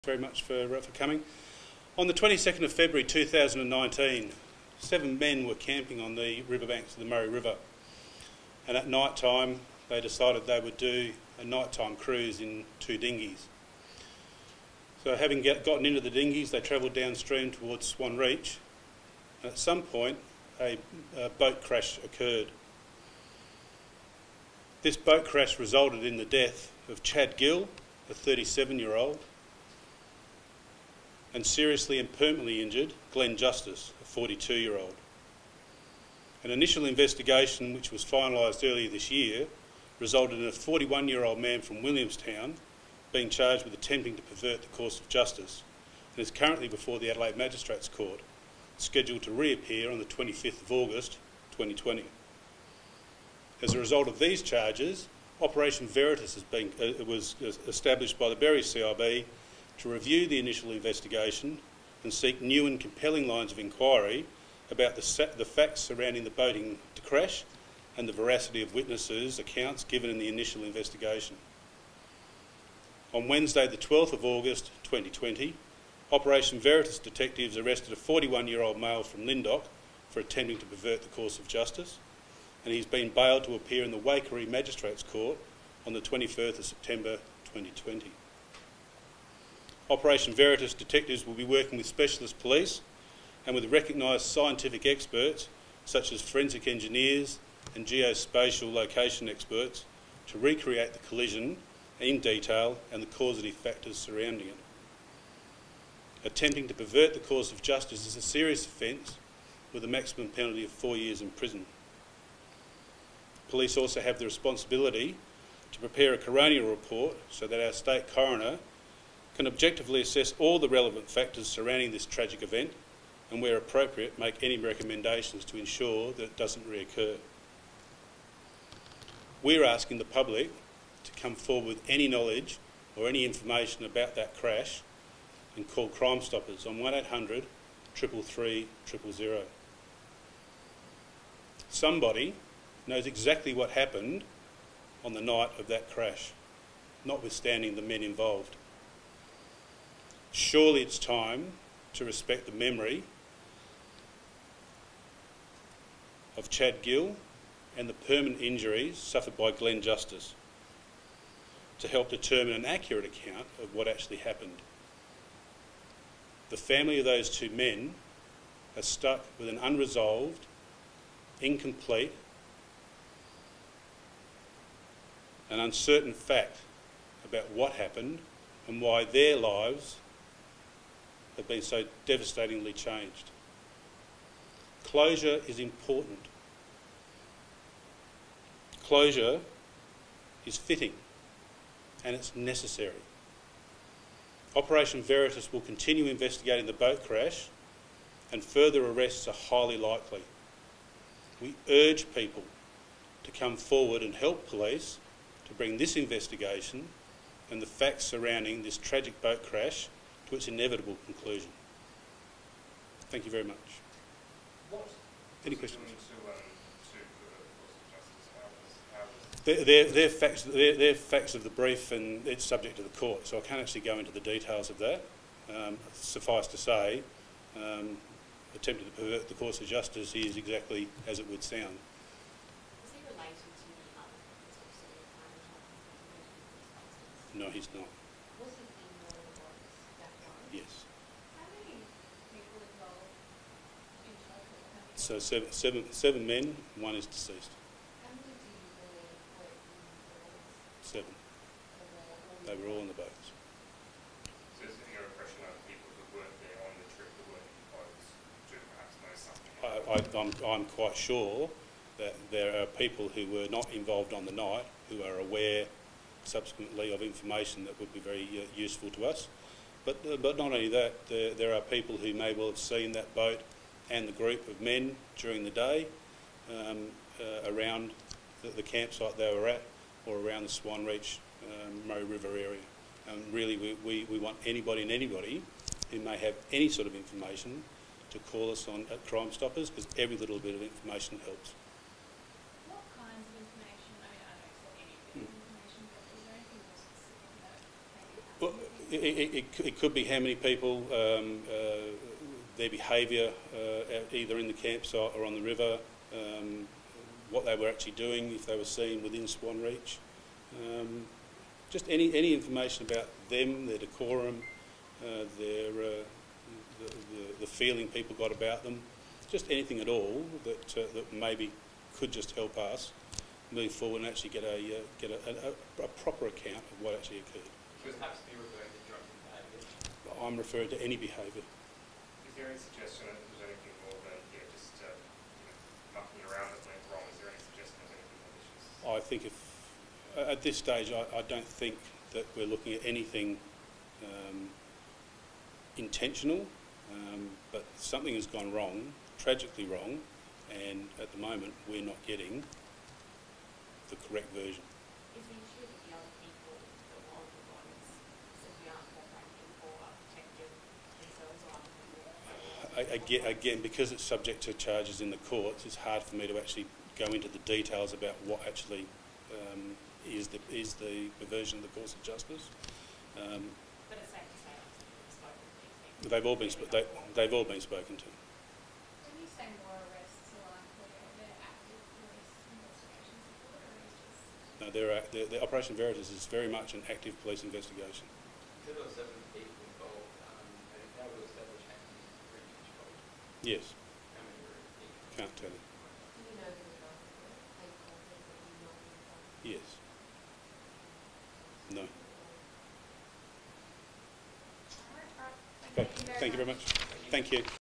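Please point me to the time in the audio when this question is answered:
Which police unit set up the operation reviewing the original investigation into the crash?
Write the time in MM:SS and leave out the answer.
00:58.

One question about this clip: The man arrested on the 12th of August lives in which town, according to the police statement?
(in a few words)
Lyndoch.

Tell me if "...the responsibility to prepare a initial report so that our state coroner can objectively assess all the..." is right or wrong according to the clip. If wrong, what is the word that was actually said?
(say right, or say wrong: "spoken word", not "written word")
wrong: "coronial", not "initial".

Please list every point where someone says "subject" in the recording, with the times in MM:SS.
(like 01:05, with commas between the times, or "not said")
03:42, 06:04.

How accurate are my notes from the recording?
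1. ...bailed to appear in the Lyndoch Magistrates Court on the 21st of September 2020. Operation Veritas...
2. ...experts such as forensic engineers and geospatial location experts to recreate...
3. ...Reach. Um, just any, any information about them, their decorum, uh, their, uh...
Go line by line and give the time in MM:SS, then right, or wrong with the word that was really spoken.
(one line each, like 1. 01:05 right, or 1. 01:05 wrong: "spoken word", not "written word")
1. 01:23 wrong: "Wakery", not "Lyndoch"
2. 01:34 right
3. 05:09 right.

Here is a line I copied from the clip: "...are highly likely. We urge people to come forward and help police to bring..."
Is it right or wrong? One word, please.
right.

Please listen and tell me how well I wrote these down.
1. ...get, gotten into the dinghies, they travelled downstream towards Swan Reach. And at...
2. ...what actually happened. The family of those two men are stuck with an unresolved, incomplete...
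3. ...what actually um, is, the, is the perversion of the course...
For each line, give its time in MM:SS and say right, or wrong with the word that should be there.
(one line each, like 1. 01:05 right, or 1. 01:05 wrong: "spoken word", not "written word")
1. 00:15 right
2. 02:43 right
3. 06:08 right.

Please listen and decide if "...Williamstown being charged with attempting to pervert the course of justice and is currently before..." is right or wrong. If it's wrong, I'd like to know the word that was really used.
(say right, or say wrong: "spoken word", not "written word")
right.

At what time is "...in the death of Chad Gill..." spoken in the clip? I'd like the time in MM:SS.
00:26.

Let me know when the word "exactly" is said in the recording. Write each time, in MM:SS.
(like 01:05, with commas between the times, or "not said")
02:23, 03:50.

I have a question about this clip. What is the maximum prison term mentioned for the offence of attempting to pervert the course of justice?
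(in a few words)
4 years.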